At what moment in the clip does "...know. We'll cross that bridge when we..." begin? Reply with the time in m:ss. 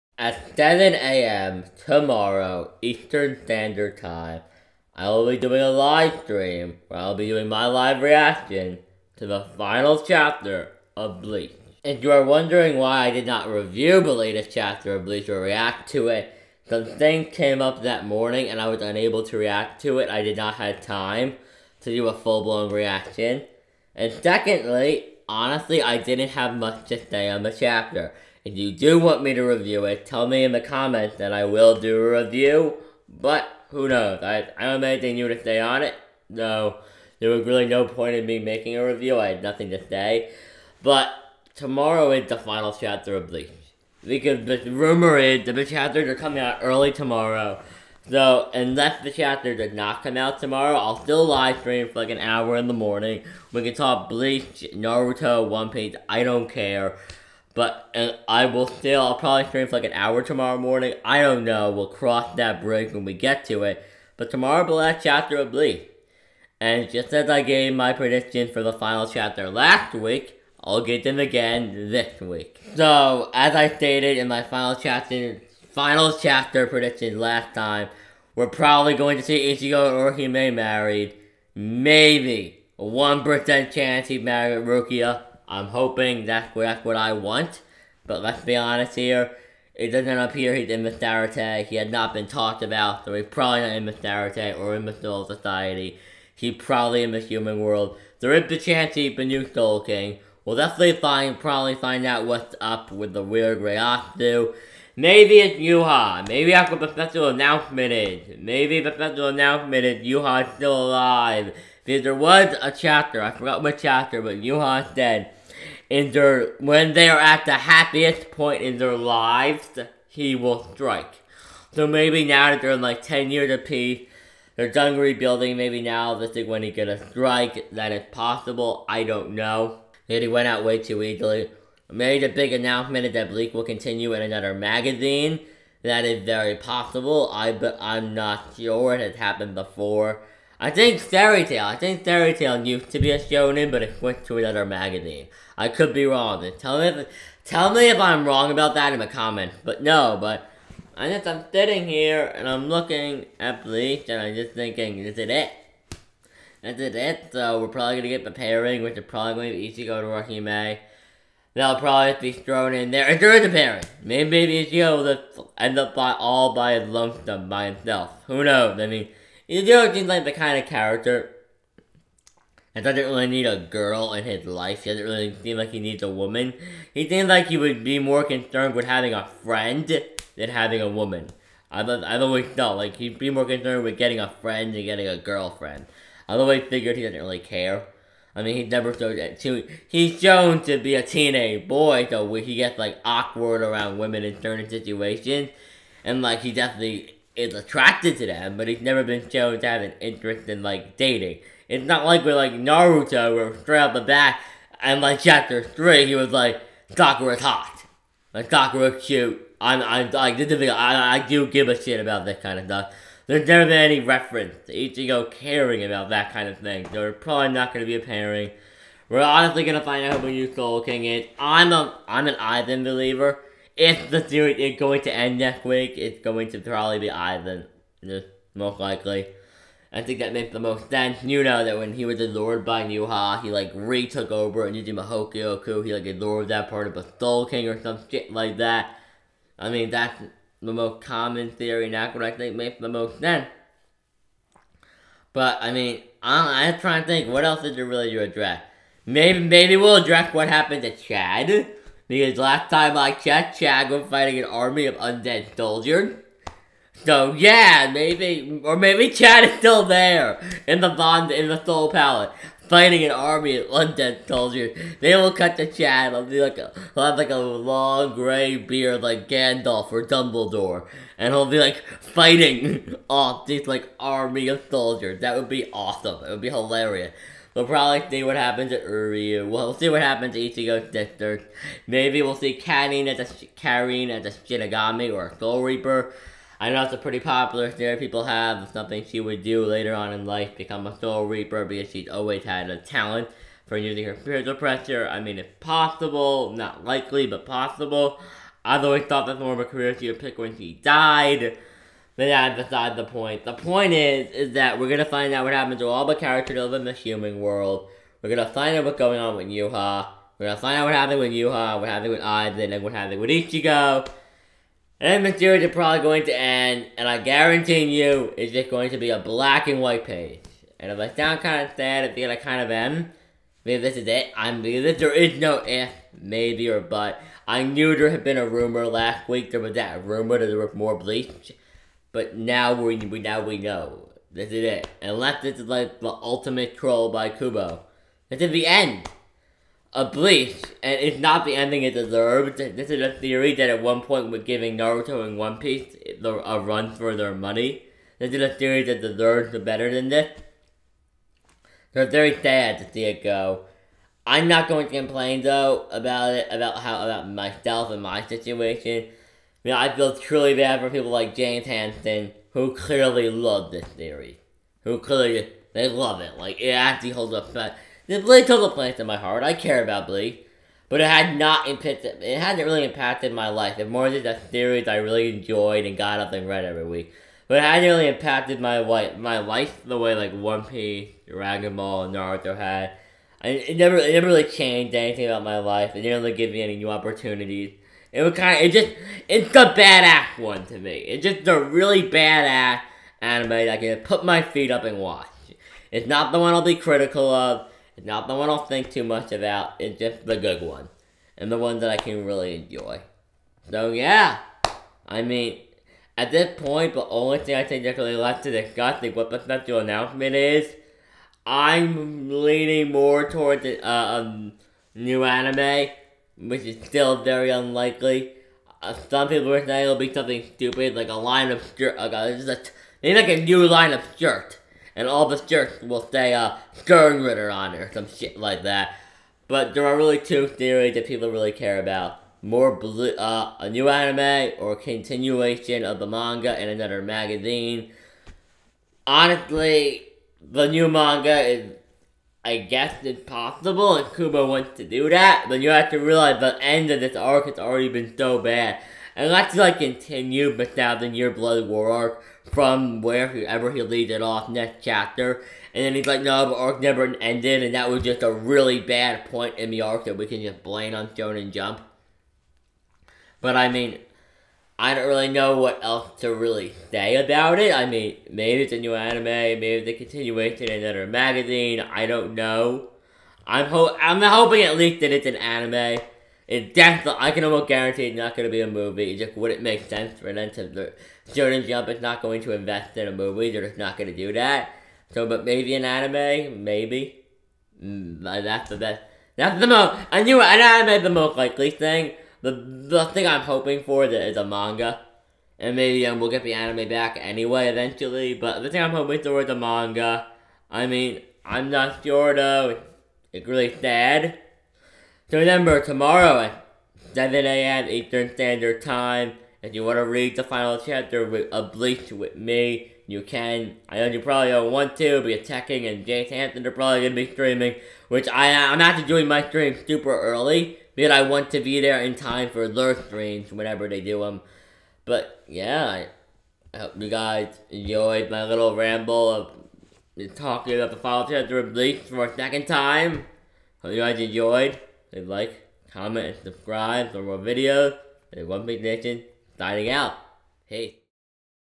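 1:01.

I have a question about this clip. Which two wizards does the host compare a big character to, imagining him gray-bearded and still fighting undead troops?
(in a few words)
Gandalf or Dumbledore.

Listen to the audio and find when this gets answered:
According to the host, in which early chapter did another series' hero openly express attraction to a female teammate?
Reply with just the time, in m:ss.
3:25.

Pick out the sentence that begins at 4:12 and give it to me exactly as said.
Because last time I checked, Chad was fighting an army of undead soldiers.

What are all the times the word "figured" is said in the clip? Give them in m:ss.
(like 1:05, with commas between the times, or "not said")
3:06.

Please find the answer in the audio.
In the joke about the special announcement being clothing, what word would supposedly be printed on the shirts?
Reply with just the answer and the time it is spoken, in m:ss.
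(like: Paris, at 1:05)
Sternritter, at 7:06.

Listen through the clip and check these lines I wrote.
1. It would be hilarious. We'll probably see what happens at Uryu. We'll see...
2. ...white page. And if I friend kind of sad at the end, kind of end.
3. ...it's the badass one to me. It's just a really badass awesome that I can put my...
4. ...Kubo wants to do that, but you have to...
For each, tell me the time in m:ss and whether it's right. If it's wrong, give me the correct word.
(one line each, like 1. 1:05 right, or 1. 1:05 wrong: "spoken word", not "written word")
1. 4:36 right
2. 5:19 wrong: "sound", not "friend"
3. 6:29 wrong: "anime", not "awesome"
4. 7:24 right.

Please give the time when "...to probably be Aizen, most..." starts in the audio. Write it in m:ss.
3:46.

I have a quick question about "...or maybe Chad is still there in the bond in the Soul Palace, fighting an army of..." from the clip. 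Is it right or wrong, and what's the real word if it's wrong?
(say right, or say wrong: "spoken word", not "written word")
right.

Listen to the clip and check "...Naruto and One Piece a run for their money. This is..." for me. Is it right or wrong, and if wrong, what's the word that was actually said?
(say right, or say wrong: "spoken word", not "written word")
right.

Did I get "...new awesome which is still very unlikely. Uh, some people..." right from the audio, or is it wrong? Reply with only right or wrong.
wrong.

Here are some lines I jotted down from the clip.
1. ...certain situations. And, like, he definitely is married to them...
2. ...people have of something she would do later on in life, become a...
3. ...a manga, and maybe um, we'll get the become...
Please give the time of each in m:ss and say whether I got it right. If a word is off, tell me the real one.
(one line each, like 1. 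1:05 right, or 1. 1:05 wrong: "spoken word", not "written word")
1. 3:14 wrong: "attracted", not "married"
2. 4:47 right
3. 8:14 wrong: "anime", not "become".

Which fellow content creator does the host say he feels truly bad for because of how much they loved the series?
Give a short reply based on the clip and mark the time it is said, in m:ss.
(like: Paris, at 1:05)
James Hansen, at 6:01.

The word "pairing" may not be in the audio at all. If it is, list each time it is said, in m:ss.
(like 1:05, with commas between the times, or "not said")
2:38, 2:43, 3:38.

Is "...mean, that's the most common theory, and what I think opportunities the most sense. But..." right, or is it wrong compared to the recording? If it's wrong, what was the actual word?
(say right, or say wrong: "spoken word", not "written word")
wrong: "makes", not "opportunities".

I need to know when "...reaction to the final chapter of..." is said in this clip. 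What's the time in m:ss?
0:08.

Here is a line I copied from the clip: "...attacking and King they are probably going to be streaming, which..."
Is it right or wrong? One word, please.
wrong.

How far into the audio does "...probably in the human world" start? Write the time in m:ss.
1:36.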